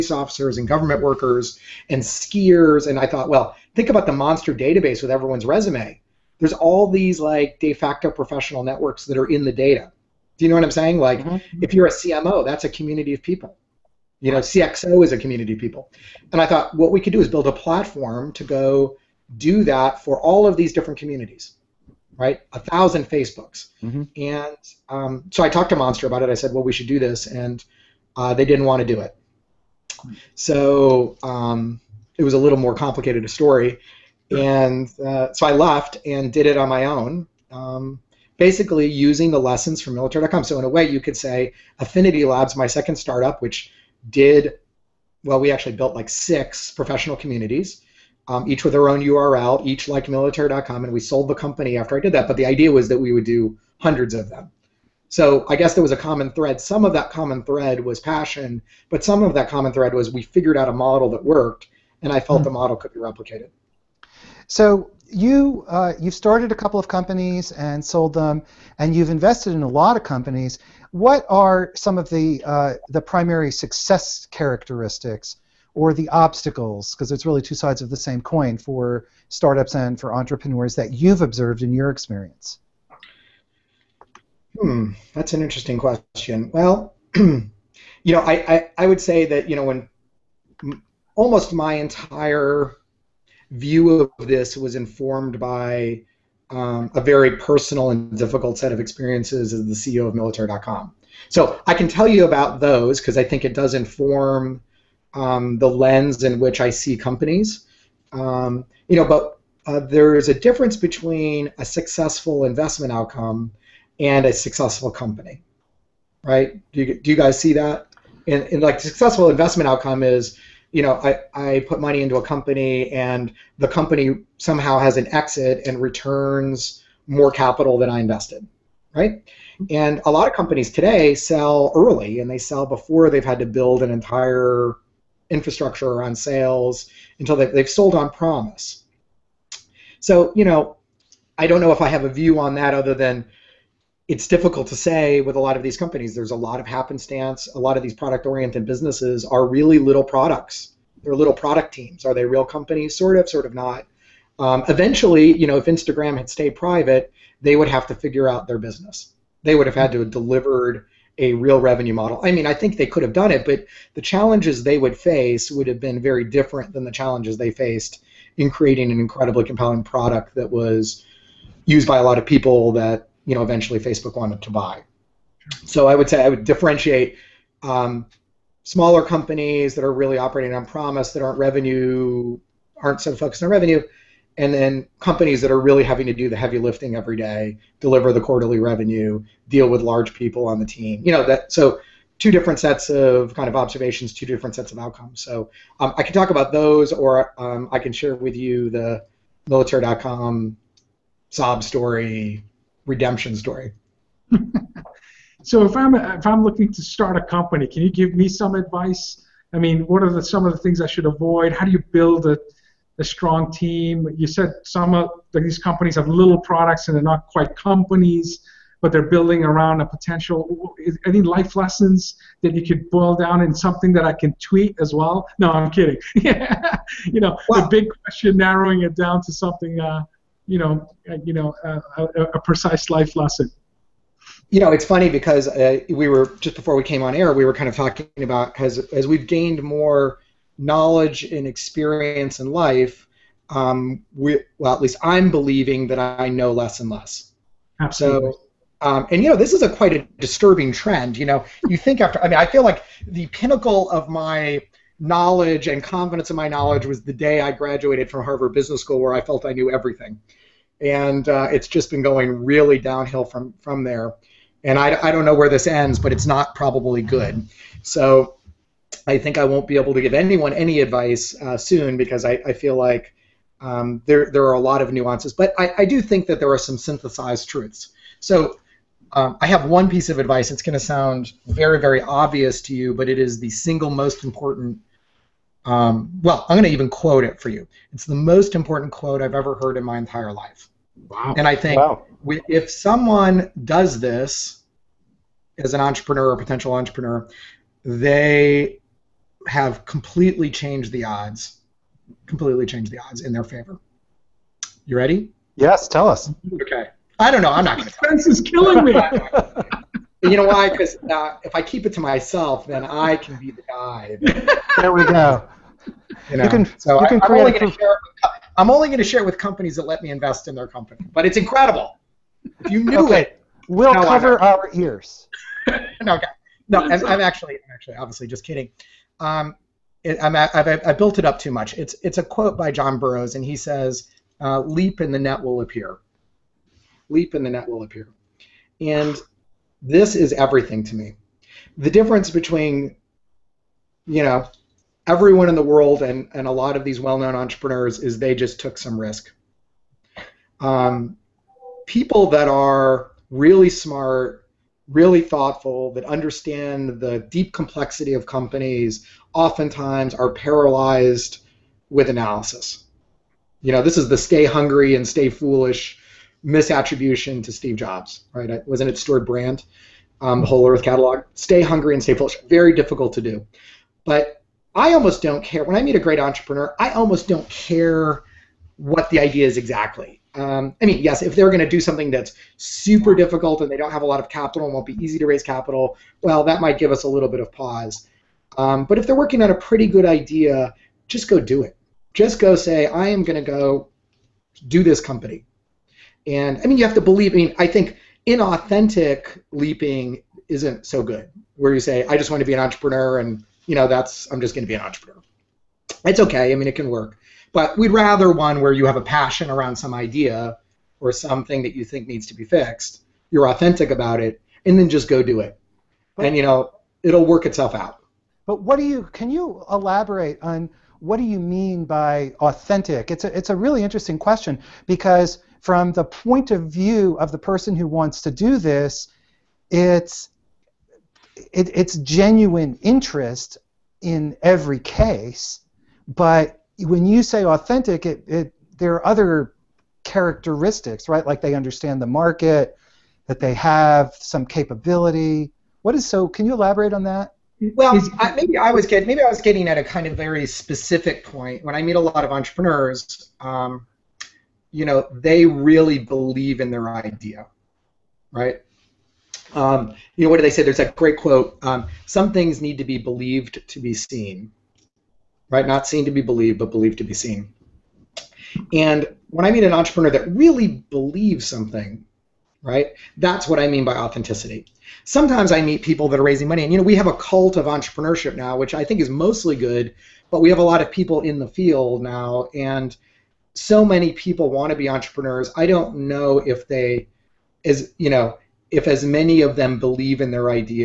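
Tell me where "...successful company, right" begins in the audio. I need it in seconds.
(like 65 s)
114 s.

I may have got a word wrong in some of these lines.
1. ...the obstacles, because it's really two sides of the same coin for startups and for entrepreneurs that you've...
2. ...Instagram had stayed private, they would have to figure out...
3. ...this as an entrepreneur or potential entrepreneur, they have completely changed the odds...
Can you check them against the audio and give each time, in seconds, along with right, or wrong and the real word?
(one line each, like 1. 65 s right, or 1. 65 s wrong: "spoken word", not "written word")
1. 75 s right
2. 155 s right
3. 293 s right.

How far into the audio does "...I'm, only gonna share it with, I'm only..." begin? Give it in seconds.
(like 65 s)
317 s.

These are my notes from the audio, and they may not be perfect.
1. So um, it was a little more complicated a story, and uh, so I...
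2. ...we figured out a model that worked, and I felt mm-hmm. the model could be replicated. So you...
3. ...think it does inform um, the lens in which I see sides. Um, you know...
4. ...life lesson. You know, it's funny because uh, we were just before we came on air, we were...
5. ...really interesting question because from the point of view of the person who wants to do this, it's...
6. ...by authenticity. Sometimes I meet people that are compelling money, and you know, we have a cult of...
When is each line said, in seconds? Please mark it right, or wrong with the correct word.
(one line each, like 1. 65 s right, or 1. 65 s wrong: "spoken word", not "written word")
1. 30 s right
2. 60 s right
3. 103 s wrong: "companies", not "sides"
4. 232 s right
5. 423 s right
6. 473 s wrong: "raising", not "compelling".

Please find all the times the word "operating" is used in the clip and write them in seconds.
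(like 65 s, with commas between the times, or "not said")
180 s.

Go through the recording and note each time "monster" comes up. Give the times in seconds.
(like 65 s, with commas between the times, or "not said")
4 s, 25 s.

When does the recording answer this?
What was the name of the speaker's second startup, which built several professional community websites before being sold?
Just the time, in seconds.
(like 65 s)
41 s.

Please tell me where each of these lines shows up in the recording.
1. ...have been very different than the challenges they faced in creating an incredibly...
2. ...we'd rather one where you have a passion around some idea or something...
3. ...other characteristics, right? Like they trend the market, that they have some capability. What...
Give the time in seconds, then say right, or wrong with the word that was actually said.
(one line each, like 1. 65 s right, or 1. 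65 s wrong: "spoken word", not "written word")
1. 165 s right
2. 407 s right
3. 439 s wrong: "understand", not "trend".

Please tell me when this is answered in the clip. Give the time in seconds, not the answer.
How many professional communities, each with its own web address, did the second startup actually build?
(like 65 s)
46 s.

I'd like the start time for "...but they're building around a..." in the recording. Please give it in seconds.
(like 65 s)
218 s.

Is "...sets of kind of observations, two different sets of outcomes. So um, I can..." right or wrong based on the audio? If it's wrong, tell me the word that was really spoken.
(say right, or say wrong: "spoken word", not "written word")
right.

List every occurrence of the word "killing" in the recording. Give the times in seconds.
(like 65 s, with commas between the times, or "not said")
308 s.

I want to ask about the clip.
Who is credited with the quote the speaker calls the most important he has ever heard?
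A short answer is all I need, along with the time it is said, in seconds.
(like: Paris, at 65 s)
John Burroughs, at 332 s.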